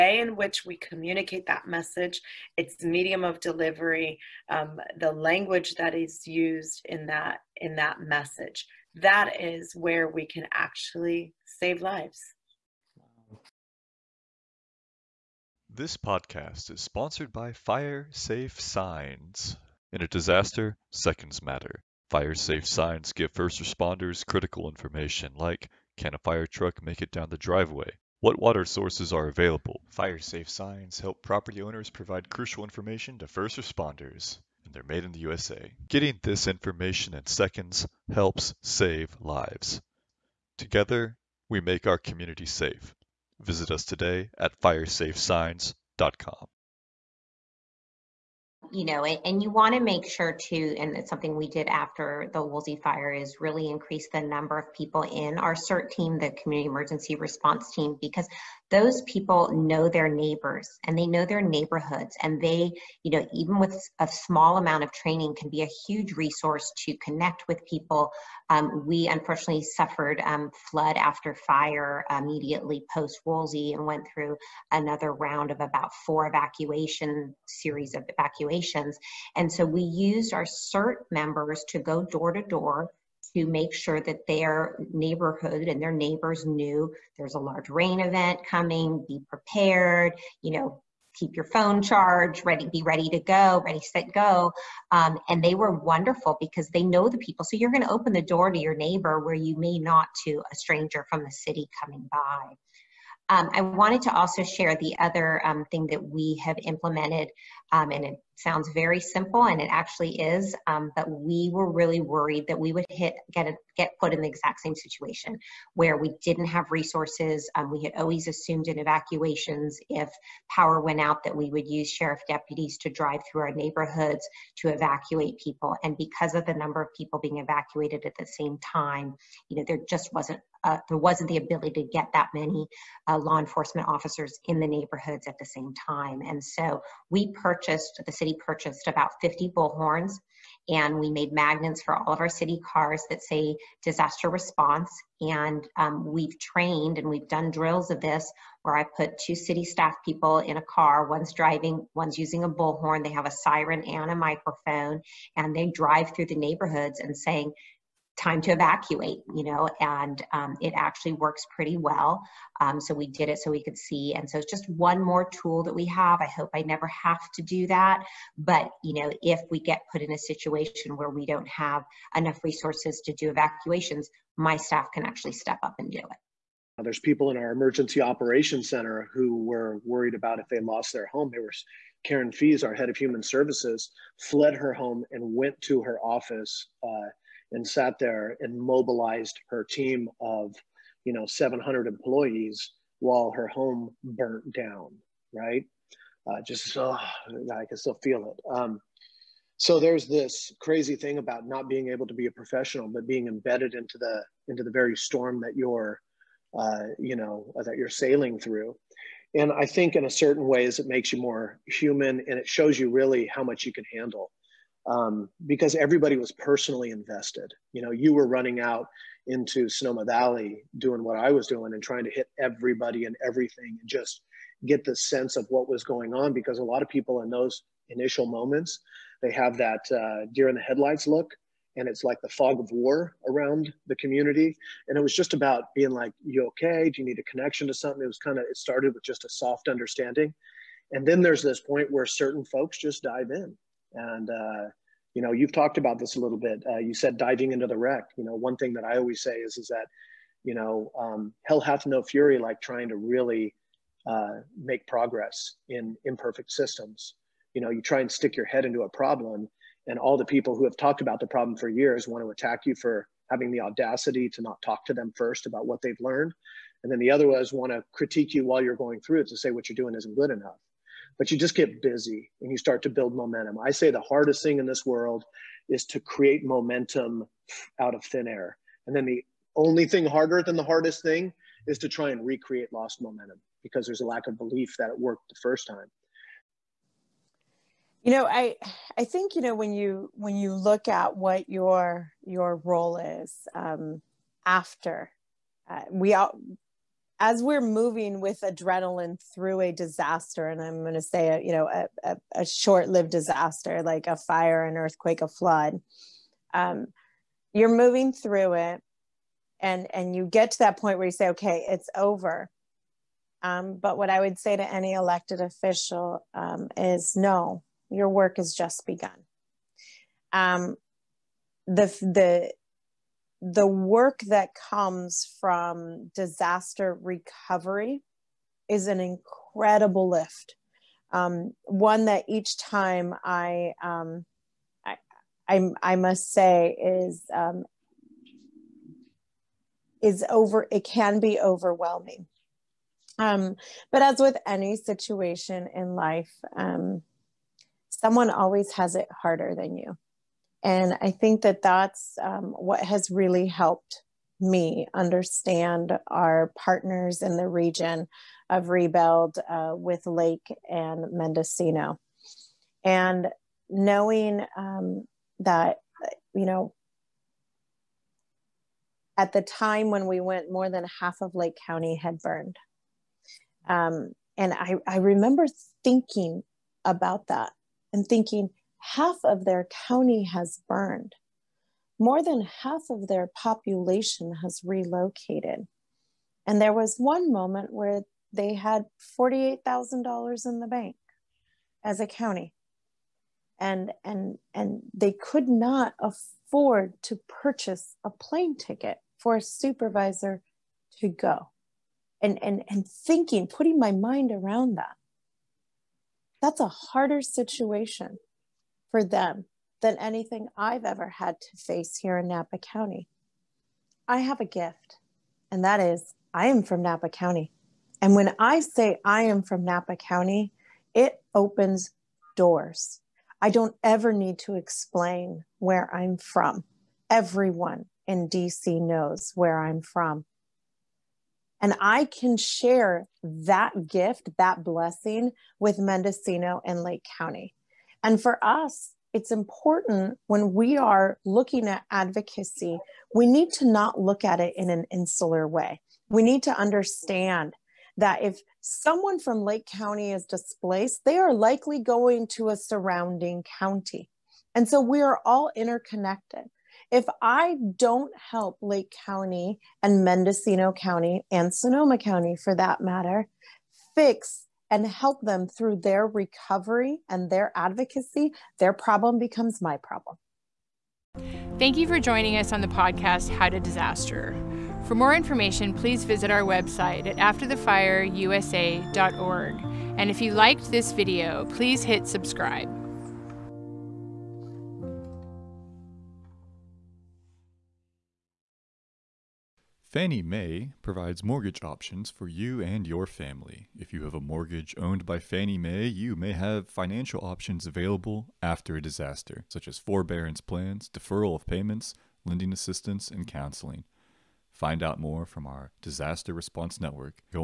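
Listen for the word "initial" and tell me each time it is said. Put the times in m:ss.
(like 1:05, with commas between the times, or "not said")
3:47.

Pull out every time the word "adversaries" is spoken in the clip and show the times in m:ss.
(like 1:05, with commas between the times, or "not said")
not said.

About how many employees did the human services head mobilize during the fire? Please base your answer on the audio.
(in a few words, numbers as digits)
700.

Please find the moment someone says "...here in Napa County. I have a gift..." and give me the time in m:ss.
6:51.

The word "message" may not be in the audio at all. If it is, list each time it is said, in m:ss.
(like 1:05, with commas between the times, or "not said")
0:01, 0:08.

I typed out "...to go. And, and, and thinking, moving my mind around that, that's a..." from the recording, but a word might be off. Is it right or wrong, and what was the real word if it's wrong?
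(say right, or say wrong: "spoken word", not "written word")
wrong: "putting", not "moving".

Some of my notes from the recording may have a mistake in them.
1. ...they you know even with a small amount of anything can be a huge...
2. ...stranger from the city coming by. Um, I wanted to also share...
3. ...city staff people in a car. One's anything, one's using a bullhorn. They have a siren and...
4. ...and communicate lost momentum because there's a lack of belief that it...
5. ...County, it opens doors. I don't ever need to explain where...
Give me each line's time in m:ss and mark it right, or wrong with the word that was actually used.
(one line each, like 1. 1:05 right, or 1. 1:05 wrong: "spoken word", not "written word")
1. 1:02 wrong: "training", not "anything"
2. 1:40 right
3. 2:29 wrong: "driving", not "anything"
4. 4:42 wrong: "recreate", not "communicate"
5. 6:59 right.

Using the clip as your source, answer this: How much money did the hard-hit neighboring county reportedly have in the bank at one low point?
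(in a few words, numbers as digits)
$48,000.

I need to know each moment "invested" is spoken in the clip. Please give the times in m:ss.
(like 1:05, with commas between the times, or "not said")
3:36.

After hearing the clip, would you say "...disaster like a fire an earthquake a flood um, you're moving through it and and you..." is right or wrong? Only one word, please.
right.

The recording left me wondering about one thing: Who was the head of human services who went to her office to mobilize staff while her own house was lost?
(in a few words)
Karen Fies.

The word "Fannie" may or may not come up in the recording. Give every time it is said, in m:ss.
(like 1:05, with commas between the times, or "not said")
8:09, 8:15.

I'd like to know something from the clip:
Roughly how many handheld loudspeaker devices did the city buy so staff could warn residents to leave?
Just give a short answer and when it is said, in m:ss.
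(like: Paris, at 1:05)
50, at 2:19.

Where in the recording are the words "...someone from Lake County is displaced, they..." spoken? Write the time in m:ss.
7:28.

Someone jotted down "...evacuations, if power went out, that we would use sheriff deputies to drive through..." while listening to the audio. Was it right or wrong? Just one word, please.
right.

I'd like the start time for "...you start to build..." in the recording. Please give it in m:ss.
4:32.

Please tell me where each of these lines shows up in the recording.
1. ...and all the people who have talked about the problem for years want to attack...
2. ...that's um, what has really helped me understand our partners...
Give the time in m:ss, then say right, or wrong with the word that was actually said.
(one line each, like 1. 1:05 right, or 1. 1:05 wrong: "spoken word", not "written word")
1. 4:19 right
2. 5:51 right.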